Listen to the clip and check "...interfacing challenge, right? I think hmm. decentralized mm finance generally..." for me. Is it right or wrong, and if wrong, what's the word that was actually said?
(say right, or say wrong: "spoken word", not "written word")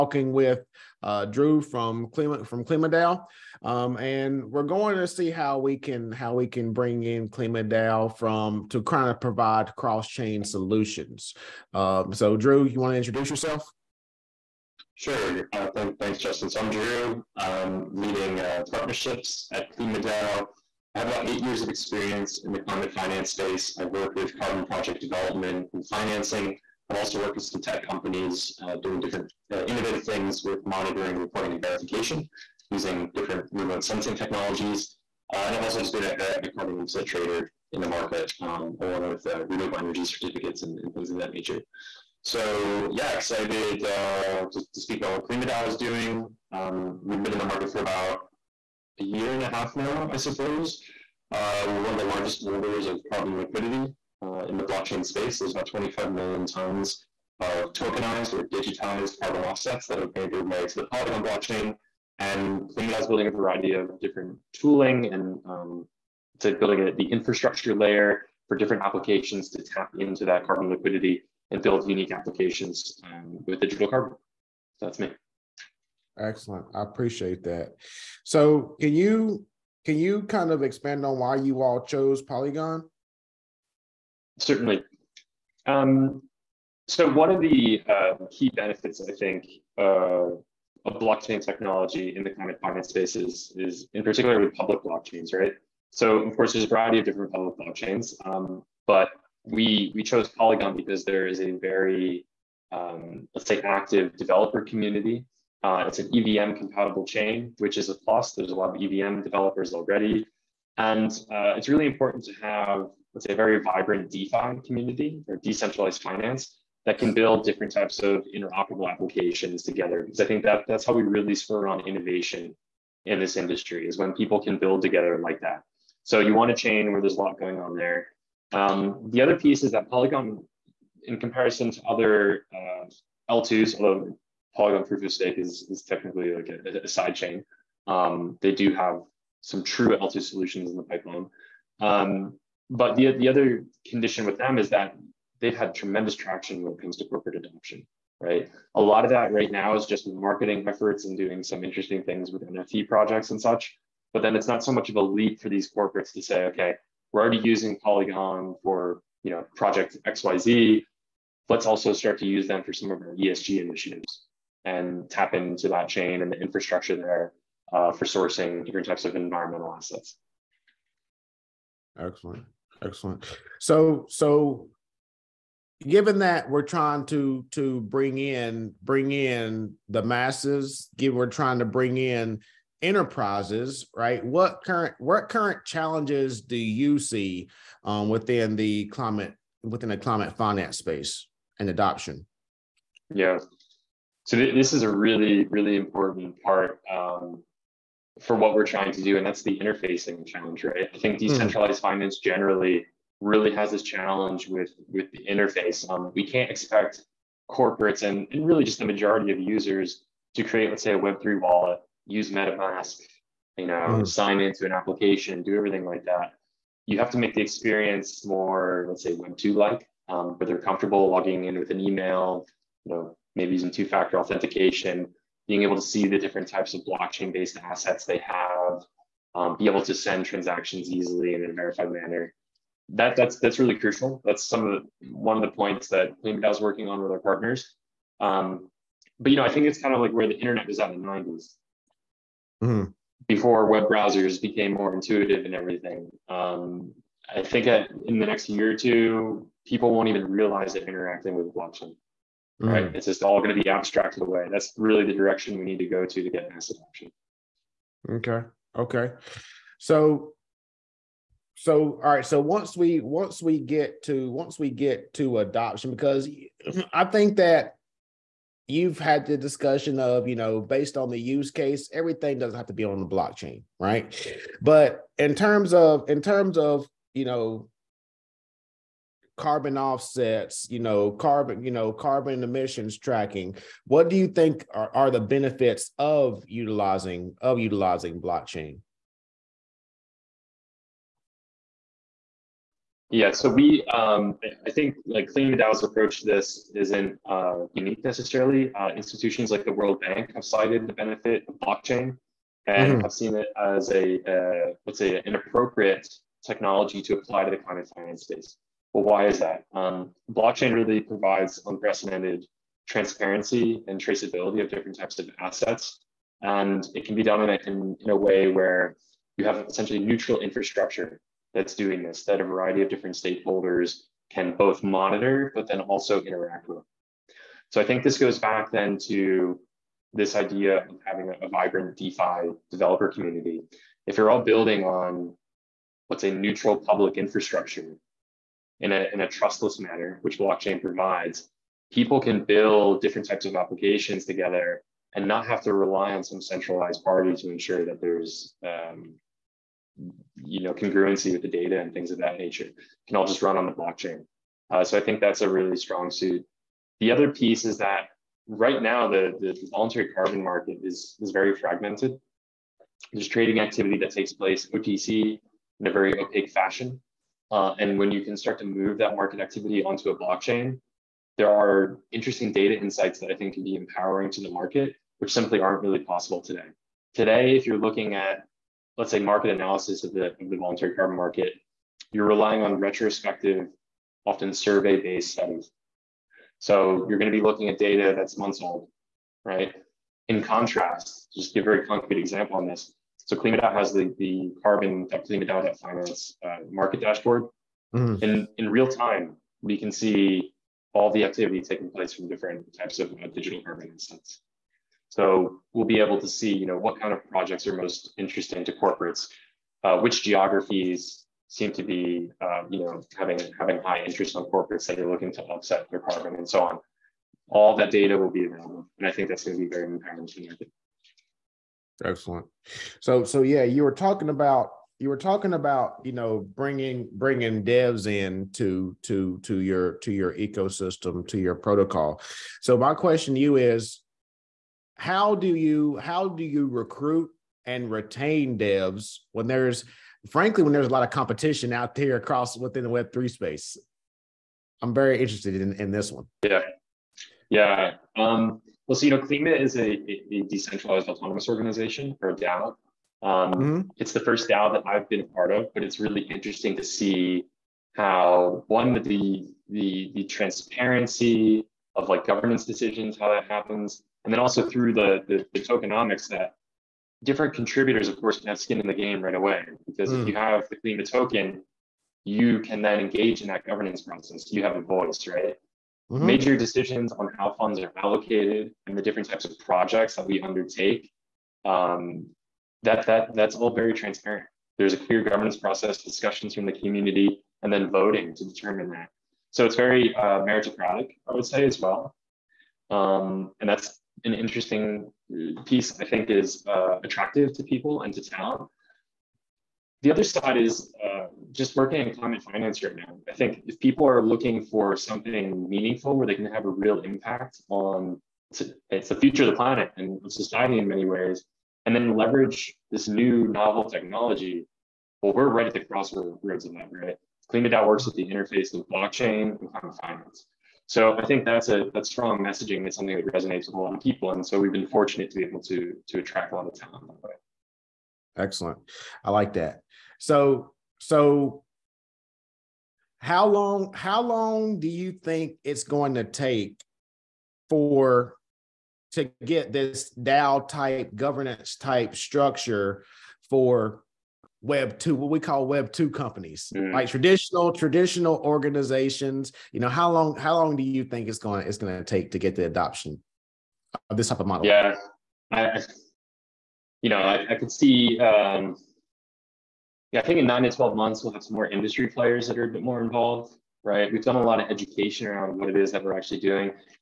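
right.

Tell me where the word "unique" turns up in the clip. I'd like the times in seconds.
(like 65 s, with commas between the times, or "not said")
71 s, 297 s.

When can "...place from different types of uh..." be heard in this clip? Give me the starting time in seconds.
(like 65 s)
401 s.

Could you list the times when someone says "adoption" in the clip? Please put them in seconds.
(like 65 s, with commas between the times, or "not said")
147 s, 191 s, 256 s, 265 s, 552 s.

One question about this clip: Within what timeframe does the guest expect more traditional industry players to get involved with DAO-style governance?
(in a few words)
9 to 12 months.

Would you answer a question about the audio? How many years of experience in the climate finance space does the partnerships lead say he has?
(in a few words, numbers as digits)
8.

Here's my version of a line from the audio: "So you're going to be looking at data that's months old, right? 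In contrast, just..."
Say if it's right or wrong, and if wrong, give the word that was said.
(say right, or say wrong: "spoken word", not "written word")
right.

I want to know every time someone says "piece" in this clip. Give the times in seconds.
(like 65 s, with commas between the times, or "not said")
129 s, 357 s, 495 s.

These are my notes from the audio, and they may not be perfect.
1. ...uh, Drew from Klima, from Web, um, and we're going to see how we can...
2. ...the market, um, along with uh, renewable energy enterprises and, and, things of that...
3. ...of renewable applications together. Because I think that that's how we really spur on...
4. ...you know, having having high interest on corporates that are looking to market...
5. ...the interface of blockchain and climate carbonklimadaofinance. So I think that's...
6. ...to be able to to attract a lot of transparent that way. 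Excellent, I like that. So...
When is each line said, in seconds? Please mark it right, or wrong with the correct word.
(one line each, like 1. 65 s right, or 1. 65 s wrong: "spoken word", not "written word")
1. 1 s wrong: "KlimaDAO", not "Web"
2. 37 s wrong: "certificates", not "enterprises"
3. 118 s wrong: "interoperable", not "renewable"
4. 412 s wrong: "offset", not "market"
5. 518 s wrong: "finance", not "carbonklimadaofinance"
6. 525 s wrong: "talent", not "transparent".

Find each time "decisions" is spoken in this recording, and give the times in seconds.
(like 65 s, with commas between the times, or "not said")
462 s, 476 s.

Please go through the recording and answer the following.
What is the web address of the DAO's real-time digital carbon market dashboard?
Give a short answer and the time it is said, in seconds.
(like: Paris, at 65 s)
carbon.klimadao.finance, at 394 s.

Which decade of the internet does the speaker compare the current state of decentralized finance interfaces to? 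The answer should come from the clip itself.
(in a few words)
the 90s.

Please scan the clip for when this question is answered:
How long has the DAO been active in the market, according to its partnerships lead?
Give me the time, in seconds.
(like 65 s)
49 s.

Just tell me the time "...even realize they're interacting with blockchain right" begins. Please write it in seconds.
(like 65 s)
250 s.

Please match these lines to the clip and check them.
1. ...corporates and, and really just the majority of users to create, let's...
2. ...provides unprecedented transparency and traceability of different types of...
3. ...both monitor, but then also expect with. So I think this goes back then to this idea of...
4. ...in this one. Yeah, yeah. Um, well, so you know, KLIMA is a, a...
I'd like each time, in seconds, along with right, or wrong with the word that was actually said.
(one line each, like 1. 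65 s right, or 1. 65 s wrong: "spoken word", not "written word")
1. 207 s right
2. 311 s right
3. 324 s wrong: "interact", not "expect"
4. 445 s right.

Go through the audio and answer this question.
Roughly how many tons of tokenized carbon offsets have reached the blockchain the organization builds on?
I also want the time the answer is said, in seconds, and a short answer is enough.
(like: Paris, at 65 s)
25 million, at 55 s.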